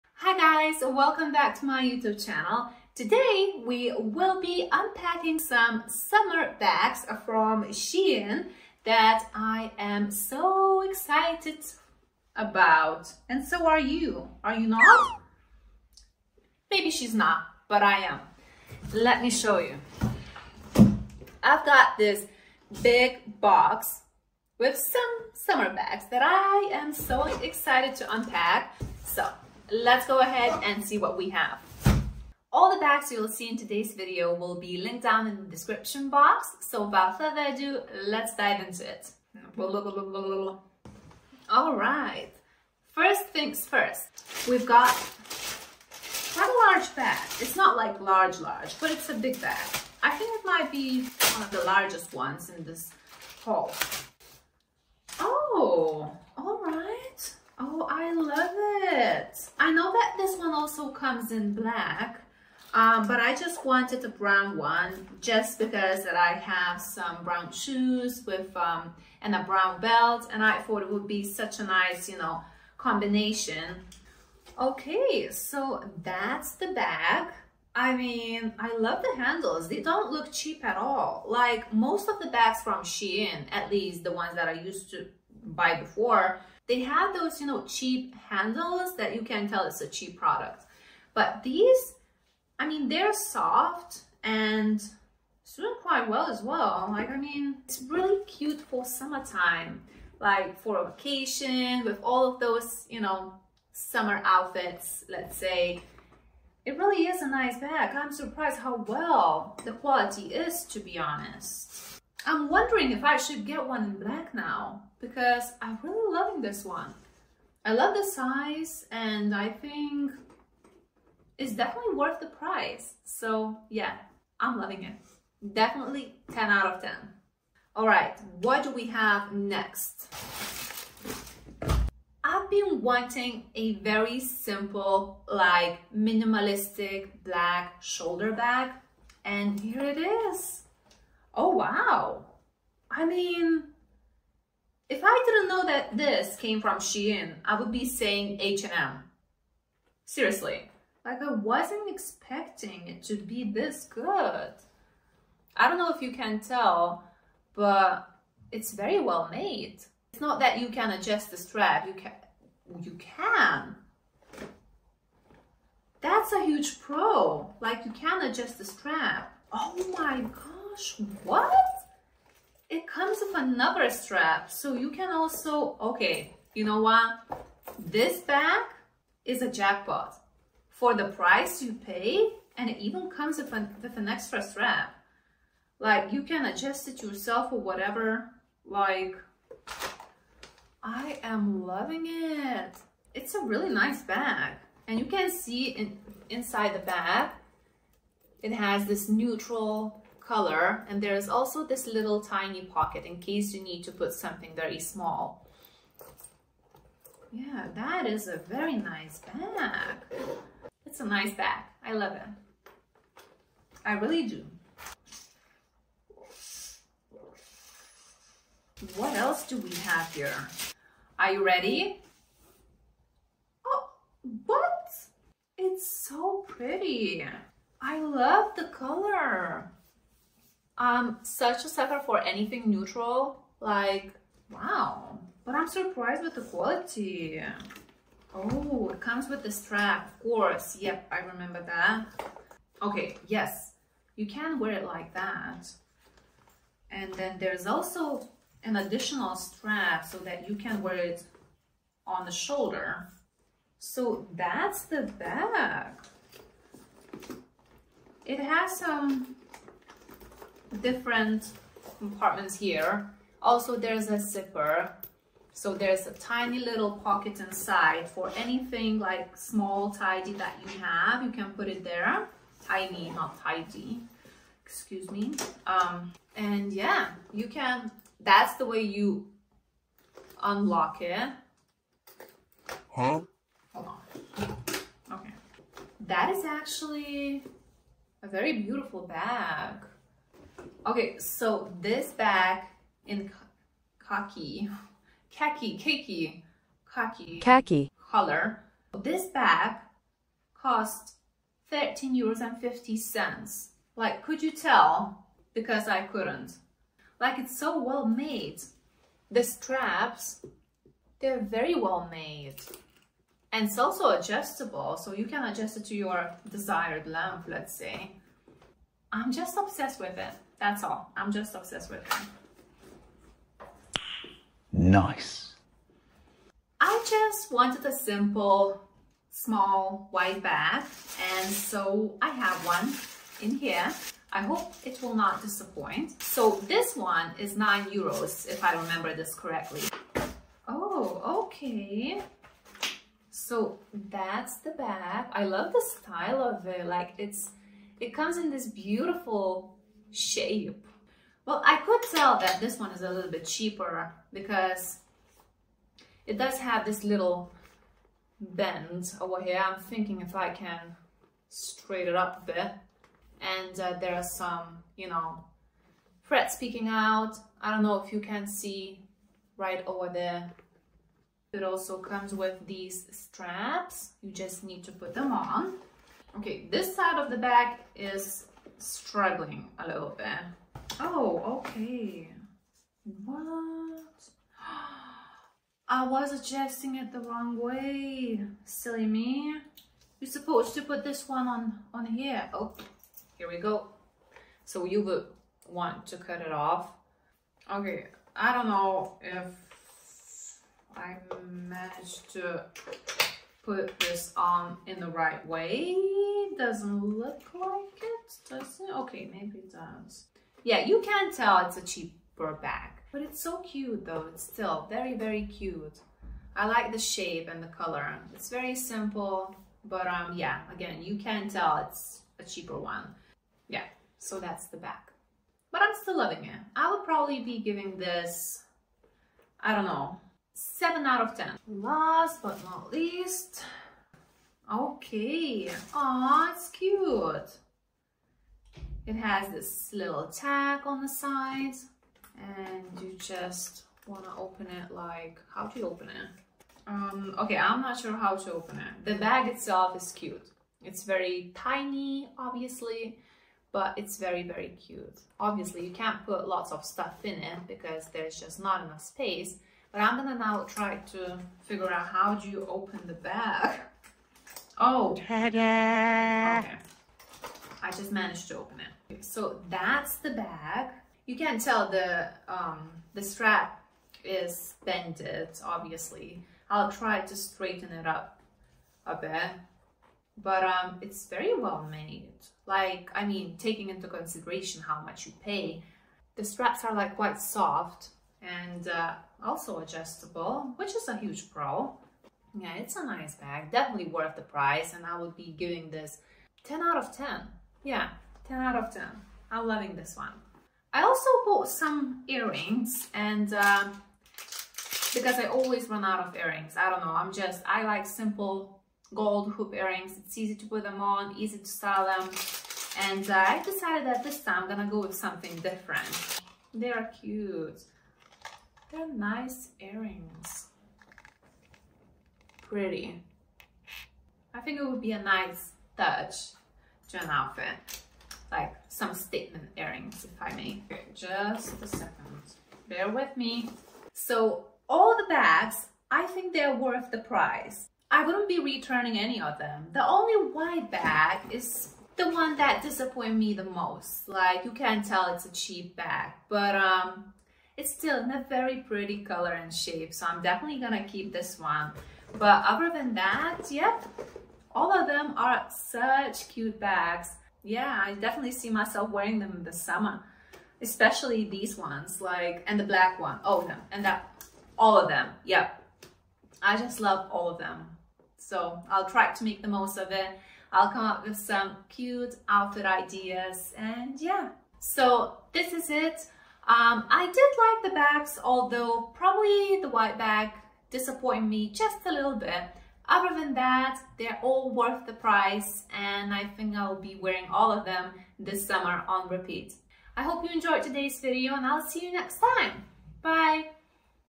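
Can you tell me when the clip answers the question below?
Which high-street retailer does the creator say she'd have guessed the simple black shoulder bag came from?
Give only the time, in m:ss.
2:28.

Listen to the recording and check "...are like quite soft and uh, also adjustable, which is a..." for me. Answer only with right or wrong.
right.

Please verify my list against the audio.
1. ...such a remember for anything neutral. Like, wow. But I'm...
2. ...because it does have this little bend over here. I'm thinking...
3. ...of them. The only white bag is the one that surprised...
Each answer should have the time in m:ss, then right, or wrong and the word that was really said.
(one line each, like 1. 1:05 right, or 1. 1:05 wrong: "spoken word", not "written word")
1. 3:51 wrong: "sucker", not "remember"
2. 5:54 right
3. 8:59 wrong: "disappointed", not "surprised".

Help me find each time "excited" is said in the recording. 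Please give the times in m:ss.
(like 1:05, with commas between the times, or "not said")
0:10, 0:27.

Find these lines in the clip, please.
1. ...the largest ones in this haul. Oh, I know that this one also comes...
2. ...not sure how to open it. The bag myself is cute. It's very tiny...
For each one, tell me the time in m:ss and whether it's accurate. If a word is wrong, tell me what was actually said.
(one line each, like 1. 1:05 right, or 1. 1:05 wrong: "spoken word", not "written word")
1. 0:51 right
2. 7:27 wrong: "itself", not "myself".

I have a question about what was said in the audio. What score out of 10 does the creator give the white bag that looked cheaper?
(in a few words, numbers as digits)
7.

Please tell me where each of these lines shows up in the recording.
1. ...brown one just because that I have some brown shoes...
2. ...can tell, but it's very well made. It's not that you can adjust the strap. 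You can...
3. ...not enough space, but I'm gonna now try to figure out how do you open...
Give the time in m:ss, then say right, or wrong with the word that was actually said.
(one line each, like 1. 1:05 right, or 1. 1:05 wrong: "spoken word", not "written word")
1. 1:04 right
2. 2:36 right
3. 7:38 right.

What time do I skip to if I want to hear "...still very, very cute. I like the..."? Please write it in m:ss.
6:54.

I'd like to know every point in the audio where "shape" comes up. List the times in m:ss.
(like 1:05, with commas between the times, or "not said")
5:50, 6:56, 9:09.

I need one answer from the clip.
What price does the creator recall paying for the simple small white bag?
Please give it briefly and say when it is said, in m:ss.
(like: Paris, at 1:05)
9 euros, at 5:37.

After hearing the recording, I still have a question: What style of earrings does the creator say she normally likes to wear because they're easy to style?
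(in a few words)
Gold hoop earrings.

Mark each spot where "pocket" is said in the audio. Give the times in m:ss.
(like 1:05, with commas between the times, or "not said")
3:22, 4:26.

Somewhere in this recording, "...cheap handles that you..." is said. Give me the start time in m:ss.
1:27.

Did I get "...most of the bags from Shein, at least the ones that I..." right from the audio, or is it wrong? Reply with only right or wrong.
right.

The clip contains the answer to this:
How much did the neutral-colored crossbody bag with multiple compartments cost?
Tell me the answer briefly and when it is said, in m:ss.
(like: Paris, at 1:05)
13 euros 50 cents, at 5:01.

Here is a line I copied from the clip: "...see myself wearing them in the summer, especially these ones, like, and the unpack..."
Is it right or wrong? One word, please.
wrong.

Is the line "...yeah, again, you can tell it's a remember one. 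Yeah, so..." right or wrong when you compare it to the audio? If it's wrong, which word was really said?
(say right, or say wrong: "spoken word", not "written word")
wrong: "cheaper", not "remember".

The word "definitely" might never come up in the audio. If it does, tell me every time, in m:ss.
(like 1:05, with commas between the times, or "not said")
2:01, 2:05, 8:13, 9:10, 9:18.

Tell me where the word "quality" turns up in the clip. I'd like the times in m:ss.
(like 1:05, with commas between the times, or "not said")
1:49, 3:56.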